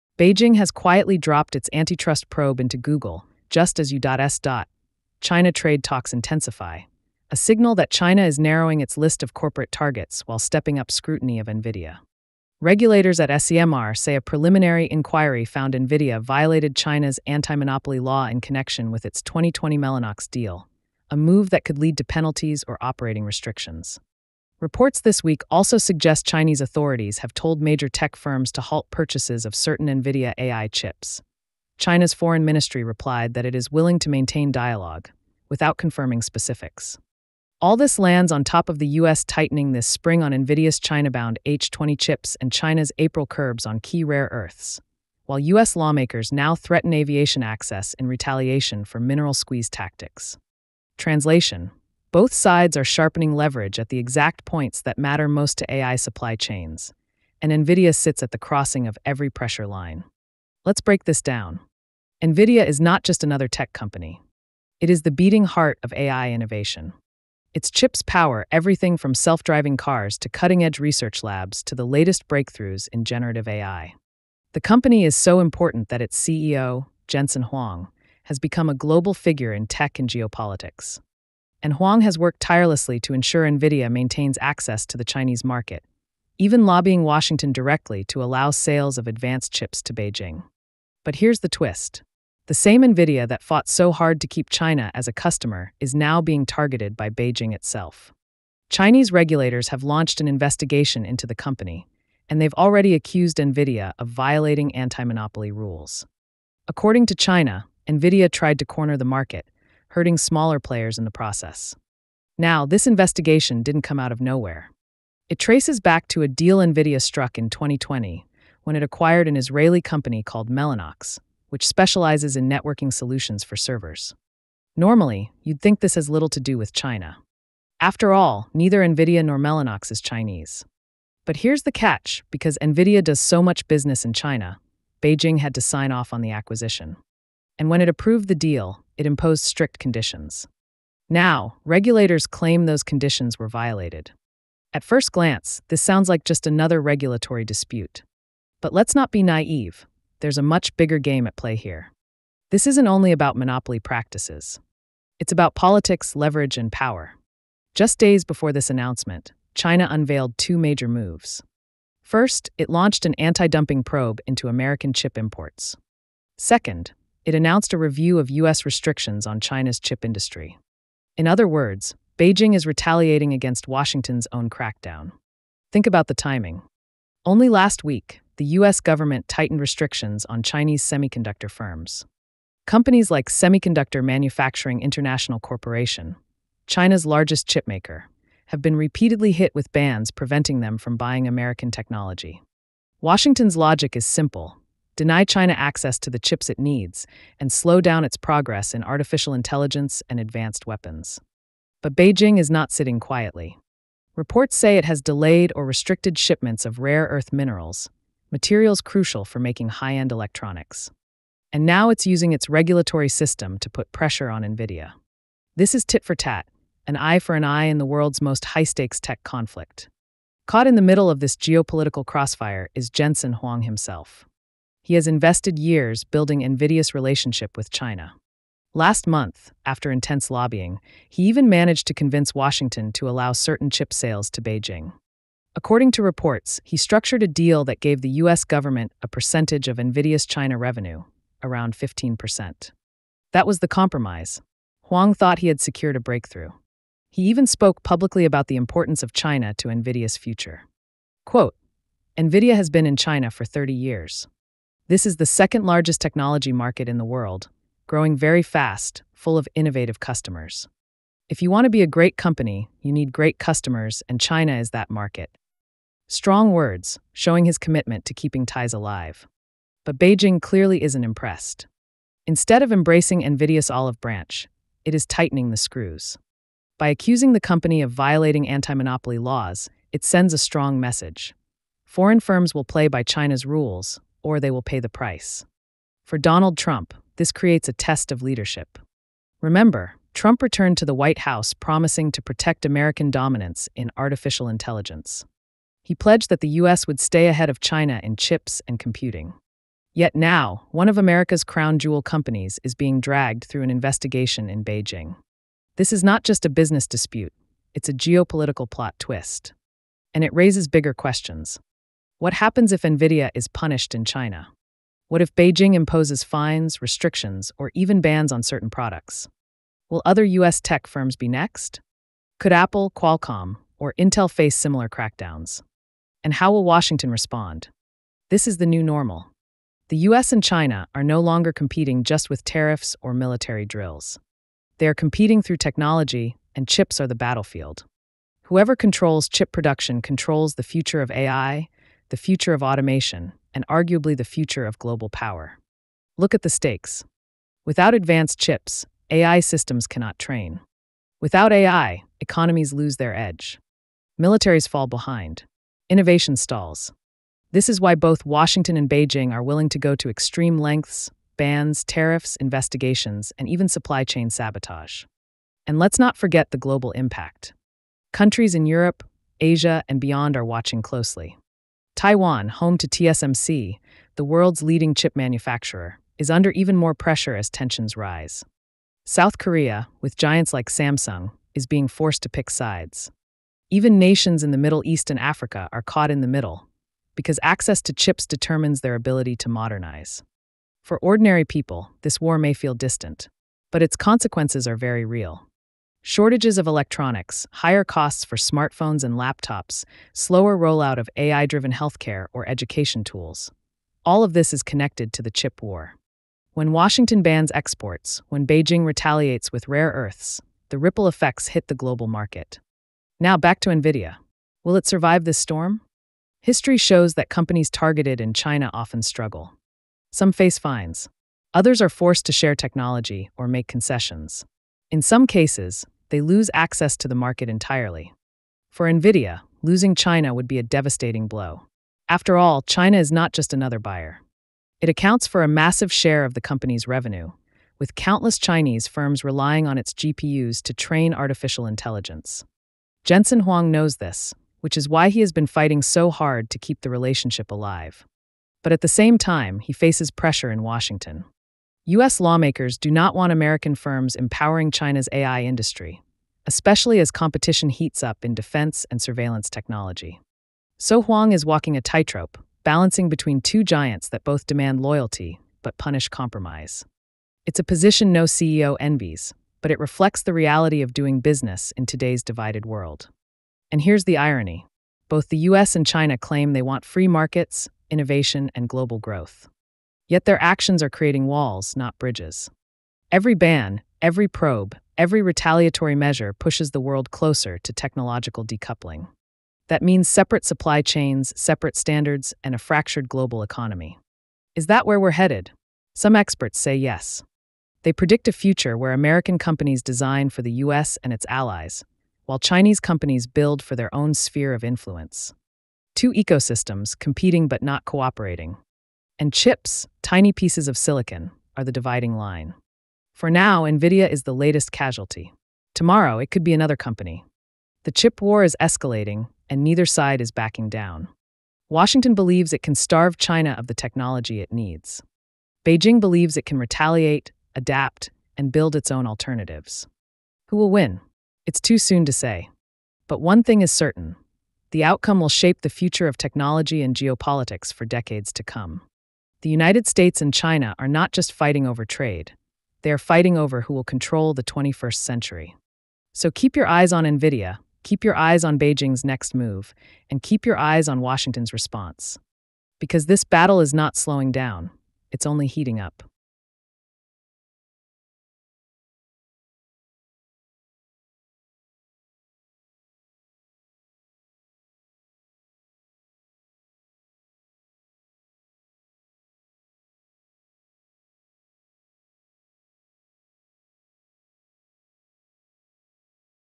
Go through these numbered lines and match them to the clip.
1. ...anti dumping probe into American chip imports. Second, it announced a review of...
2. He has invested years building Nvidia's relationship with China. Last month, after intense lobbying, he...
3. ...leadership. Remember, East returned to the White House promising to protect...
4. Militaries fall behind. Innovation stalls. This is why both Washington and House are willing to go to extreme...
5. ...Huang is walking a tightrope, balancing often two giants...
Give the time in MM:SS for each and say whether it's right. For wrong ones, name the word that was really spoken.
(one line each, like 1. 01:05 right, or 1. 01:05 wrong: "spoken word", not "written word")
1. 02:43 right
2. 03:44 right
3. 04:48 wrong: "Trump", not "East"
4. 05:54 wrong: "Beijing", not "House"
5. 07:41 wrong: "between", not "often".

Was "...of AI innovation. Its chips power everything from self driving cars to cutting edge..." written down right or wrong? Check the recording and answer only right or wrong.
right.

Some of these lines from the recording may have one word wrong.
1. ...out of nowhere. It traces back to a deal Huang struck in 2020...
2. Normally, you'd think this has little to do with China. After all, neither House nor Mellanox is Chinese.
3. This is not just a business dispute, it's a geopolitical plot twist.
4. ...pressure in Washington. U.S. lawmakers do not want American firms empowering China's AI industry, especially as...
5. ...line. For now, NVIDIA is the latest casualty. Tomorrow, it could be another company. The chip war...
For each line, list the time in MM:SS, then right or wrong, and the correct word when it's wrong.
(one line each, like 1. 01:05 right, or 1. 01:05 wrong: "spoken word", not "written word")
1. 01:53 wrong: "NVIDIA", not "Huang"
2. 02:04 wrong: "NVIDIA", not "House"
3. 05:05 right
4. 07:30 right
5. 08:32 right.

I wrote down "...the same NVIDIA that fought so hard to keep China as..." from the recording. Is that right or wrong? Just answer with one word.
right.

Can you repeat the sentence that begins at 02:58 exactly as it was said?
government tightened restrictions on Chinese semiconductor firms.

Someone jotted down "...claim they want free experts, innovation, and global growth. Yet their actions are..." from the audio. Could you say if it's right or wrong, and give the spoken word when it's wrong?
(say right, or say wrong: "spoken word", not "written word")
wrong: "markets", not "experts".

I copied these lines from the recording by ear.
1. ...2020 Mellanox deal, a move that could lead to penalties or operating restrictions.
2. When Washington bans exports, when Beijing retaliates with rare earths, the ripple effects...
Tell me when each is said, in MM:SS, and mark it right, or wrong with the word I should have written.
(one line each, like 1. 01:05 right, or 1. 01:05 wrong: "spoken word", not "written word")
1. 00:19 right
2. 06:46 right.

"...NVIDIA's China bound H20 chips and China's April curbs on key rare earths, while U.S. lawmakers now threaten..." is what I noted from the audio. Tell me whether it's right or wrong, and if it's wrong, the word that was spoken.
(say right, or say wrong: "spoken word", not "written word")
right.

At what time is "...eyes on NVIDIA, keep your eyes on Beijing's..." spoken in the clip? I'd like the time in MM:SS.
09:06.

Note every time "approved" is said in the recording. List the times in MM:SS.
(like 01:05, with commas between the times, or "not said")
02:17.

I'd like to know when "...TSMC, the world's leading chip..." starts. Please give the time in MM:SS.
06:12.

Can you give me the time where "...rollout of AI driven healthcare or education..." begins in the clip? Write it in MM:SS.
06:40.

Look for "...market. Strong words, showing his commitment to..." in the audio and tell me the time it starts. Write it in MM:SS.
04:24.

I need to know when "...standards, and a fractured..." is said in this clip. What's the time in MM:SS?
08:11.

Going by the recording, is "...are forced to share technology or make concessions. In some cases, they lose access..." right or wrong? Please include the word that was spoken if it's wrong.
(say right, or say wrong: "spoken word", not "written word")
right.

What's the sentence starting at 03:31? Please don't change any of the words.
And now it's using its regulatory system to put pressure on NVIDIA.